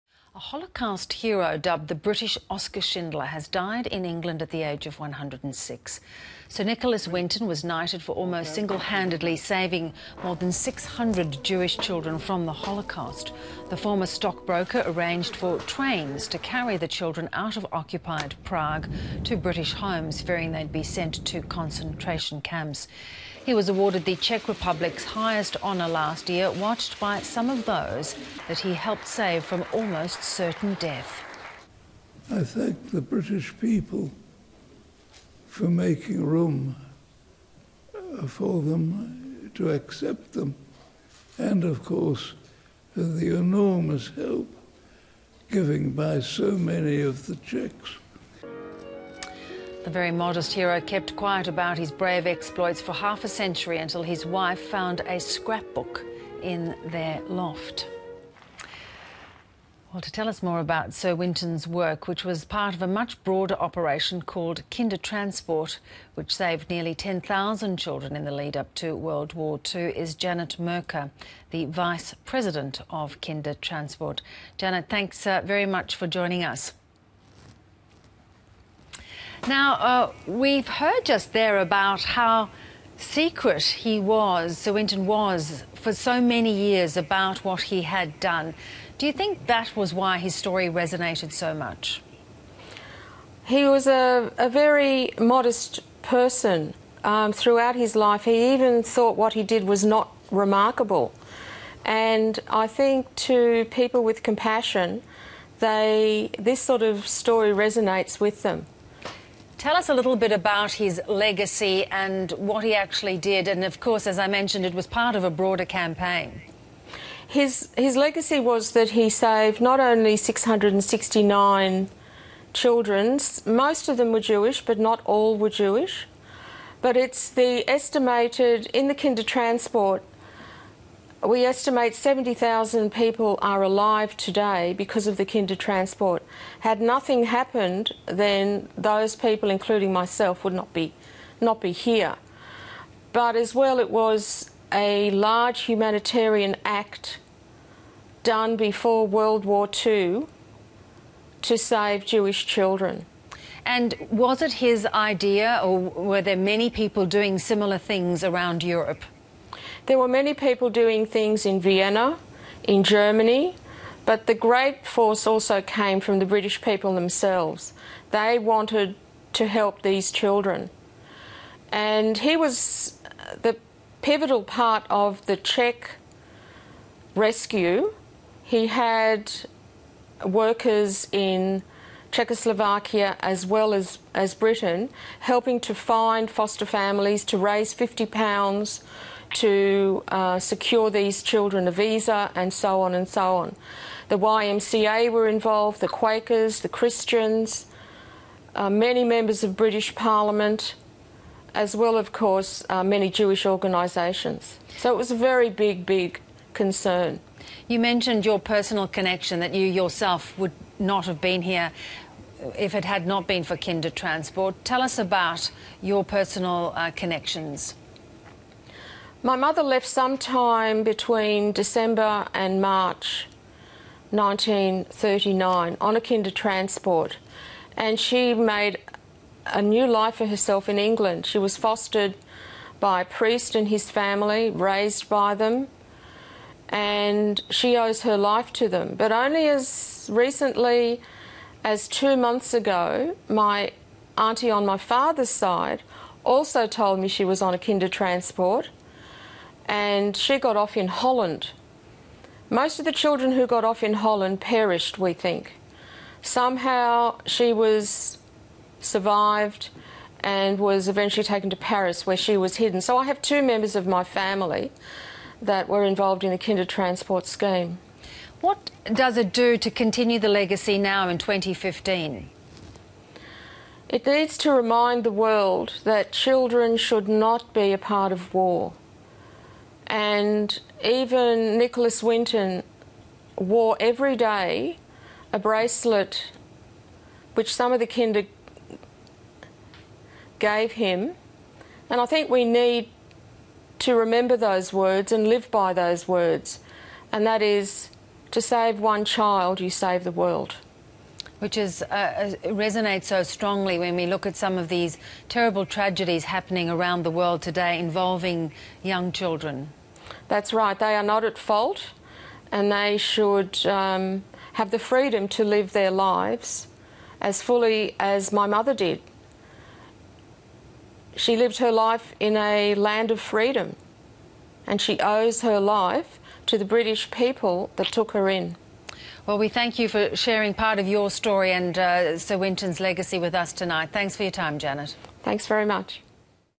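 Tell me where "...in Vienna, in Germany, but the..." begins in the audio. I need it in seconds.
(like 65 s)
161 s.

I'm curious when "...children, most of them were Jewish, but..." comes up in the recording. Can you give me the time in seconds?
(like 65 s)
122 s.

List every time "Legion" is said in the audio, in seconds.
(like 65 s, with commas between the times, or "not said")
not said.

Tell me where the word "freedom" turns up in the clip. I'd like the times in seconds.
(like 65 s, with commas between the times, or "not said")
314 s, 323 s.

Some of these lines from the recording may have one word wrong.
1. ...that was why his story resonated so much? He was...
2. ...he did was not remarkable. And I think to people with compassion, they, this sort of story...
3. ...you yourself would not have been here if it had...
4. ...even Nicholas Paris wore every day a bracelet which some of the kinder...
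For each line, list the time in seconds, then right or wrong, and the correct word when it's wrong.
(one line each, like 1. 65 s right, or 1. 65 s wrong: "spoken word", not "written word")
1. 89 s right
2. 99 s right
3. 209 s right
4. 280 s wrong: "Winton", not "Paris".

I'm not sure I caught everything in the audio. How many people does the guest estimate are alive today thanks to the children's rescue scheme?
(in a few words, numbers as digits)
70,000.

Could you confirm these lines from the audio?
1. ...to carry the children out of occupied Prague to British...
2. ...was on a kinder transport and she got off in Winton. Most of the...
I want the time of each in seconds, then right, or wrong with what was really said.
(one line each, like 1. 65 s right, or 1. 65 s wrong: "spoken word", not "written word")
1. 16 s right
2. 247 s wrong: "Holland", not "Winton".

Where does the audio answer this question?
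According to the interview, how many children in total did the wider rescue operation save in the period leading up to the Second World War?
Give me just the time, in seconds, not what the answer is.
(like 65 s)
66 s.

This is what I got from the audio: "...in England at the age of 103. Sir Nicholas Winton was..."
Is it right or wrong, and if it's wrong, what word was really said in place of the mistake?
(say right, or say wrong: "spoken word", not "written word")
wrong: "106", not "103".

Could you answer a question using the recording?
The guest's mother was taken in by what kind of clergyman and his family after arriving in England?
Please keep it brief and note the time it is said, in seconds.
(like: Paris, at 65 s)
a priest, at 233 s.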